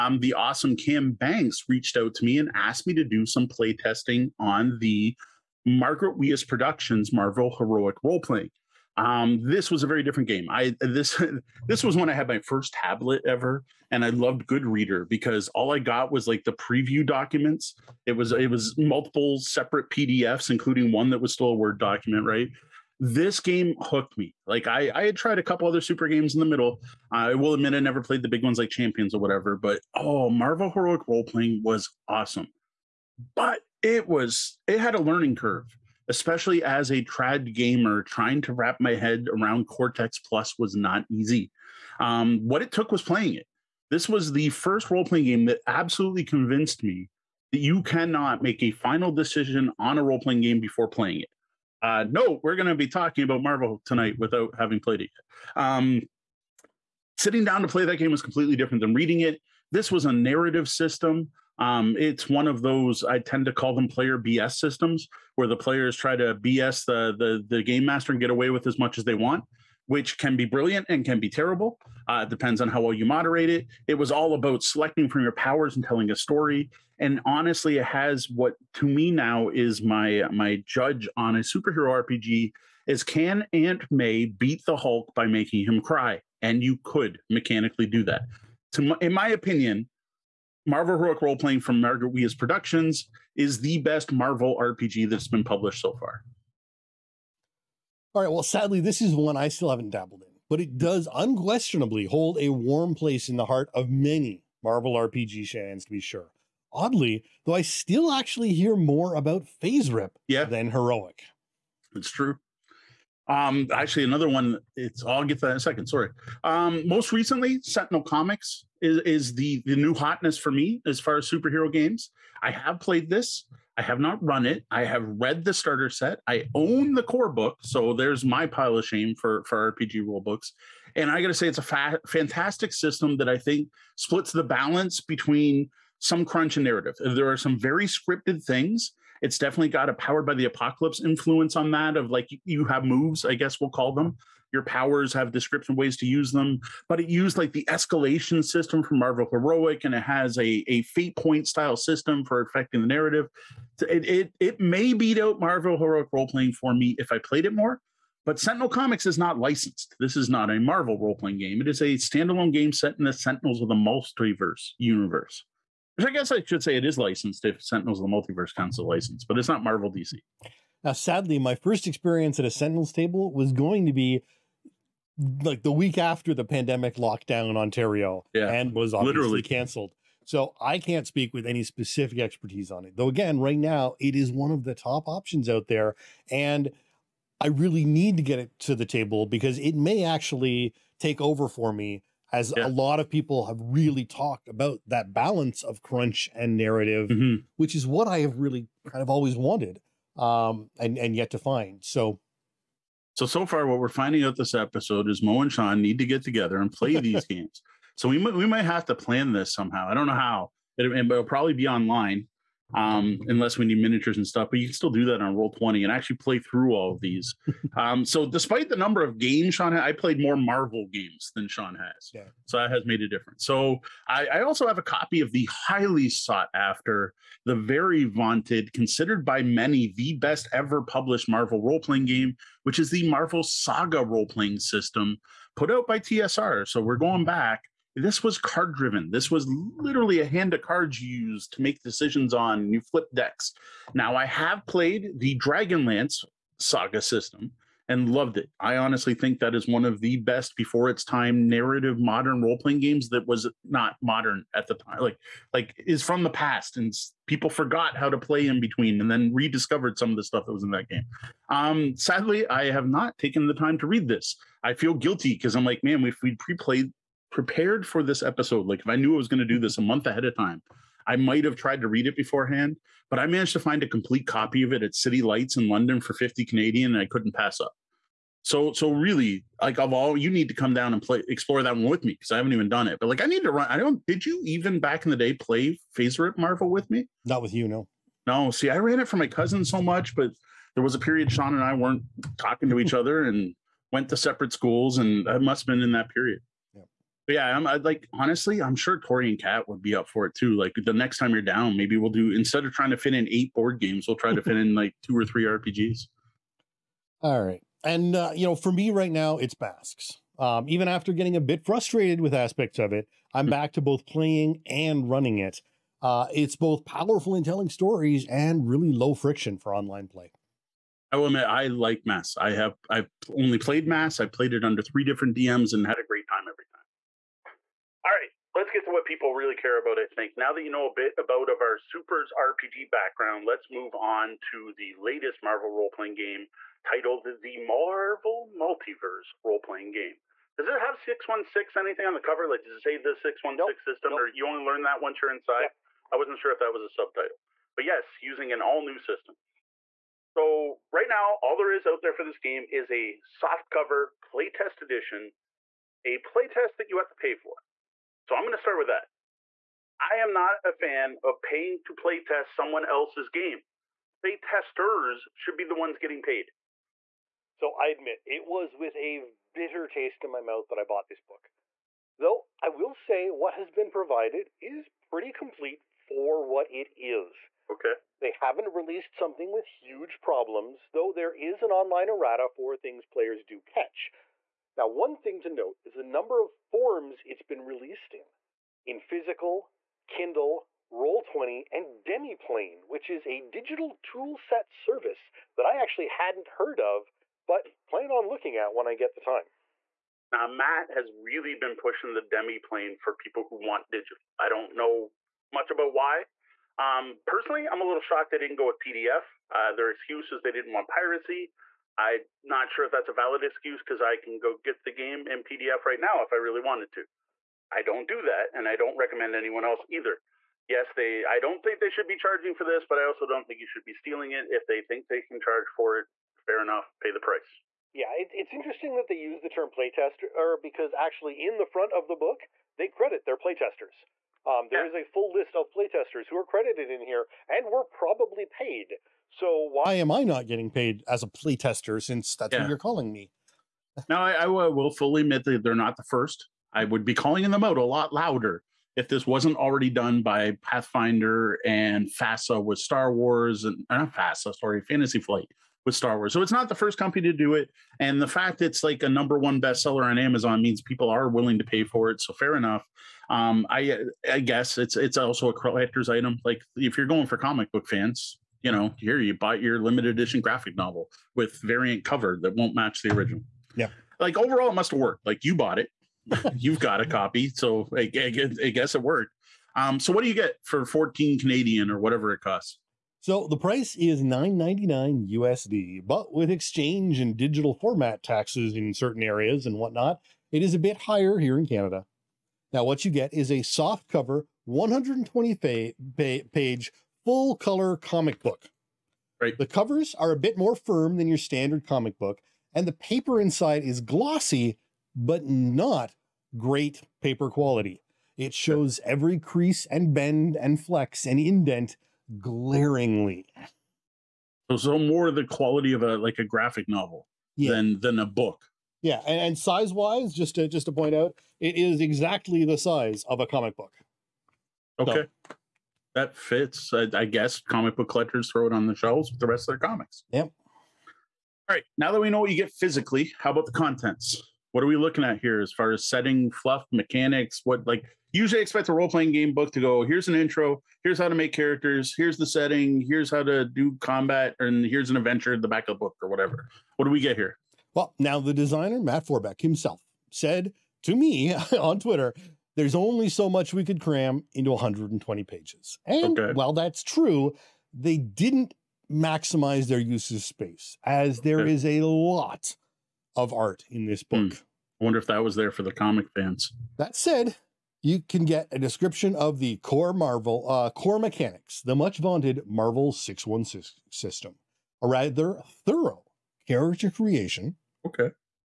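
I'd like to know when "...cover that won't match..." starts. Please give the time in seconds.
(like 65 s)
472 s.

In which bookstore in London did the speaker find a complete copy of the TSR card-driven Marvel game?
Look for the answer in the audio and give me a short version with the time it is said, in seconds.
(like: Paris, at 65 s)
City Lights, at 274 s.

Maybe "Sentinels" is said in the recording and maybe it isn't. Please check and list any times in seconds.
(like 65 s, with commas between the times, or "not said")
117 s, 158 s, 163 s, 167 s, 172 s.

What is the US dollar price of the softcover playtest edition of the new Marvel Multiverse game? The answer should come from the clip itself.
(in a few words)
9.99 USD.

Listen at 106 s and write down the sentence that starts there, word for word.
Oddly, though, I still actually hear more about FASERIP yeah.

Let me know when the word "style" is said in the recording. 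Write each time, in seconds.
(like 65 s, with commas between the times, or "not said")
151 s.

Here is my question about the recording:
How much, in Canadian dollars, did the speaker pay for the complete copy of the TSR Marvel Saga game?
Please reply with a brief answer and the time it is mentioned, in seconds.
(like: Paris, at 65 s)
50, at 276 s.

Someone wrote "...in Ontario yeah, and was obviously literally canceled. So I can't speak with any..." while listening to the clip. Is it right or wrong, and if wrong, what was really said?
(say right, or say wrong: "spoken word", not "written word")
right.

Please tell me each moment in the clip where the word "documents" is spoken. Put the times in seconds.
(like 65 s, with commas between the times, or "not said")
17 s, 21 s.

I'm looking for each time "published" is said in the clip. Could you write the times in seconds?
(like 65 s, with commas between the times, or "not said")
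95 s, 230 s.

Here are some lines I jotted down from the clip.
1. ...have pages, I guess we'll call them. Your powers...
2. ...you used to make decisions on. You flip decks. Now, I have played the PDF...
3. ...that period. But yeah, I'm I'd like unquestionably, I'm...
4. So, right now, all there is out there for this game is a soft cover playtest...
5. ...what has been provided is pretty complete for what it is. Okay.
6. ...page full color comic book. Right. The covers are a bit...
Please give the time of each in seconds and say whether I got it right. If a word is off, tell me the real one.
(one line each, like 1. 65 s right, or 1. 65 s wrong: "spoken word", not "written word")
1. 142 s wrong: "moves", not "pages"
2. 241 s wrong: "Dragonlance", not "PDF"
3. 295 s wrong: "honestly", not "unquestionably"
4. 350 s right
5. 373 s right
6. 496 s right.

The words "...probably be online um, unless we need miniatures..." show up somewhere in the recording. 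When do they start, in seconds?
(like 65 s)
211 s.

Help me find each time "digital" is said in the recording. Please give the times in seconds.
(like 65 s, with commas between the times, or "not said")
393 s, 403 s, 487 s.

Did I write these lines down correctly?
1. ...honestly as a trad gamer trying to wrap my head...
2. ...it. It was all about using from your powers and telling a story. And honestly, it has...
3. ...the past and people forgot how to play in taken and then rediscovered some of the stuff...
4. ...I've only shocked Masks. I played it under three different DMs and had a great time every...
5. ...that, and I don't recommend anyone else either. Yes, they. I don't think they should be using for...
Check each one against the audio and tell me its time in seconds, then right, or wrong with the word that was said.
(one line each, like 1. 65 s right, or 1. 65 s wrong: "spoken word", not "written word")
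1. 36 s wrong: "especially", not "honestly"
2. 73 s wrong: "selecting", not "using"
3. 256 s wrong: "between", not "taken"
4. 322 s wrong: "played", not "shocked"
5. 418 s wrong: "charging", not "using".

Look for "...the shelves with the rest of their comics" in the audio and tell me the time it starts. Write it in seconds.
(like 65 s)
528 s.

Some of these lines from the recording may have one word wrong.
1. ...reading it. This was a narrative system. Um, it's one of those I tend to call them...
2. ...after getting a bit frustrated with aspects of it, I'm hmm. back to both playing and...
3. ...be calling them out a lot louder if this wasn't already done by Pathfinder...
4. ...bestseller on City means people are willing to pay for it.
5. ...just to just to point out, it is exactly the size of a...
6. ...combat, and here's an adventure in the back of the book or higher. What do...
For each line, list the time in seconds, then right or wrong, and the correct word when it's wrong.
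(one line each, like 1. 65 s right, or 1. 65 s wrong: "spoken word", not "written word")
1. 58 s right
2. 310 s right
3. 447 s right
4. 459 s wrong: "Amazon", not "City"
5. 520 s right
6. 544 s wrong: "whatever", not "higher".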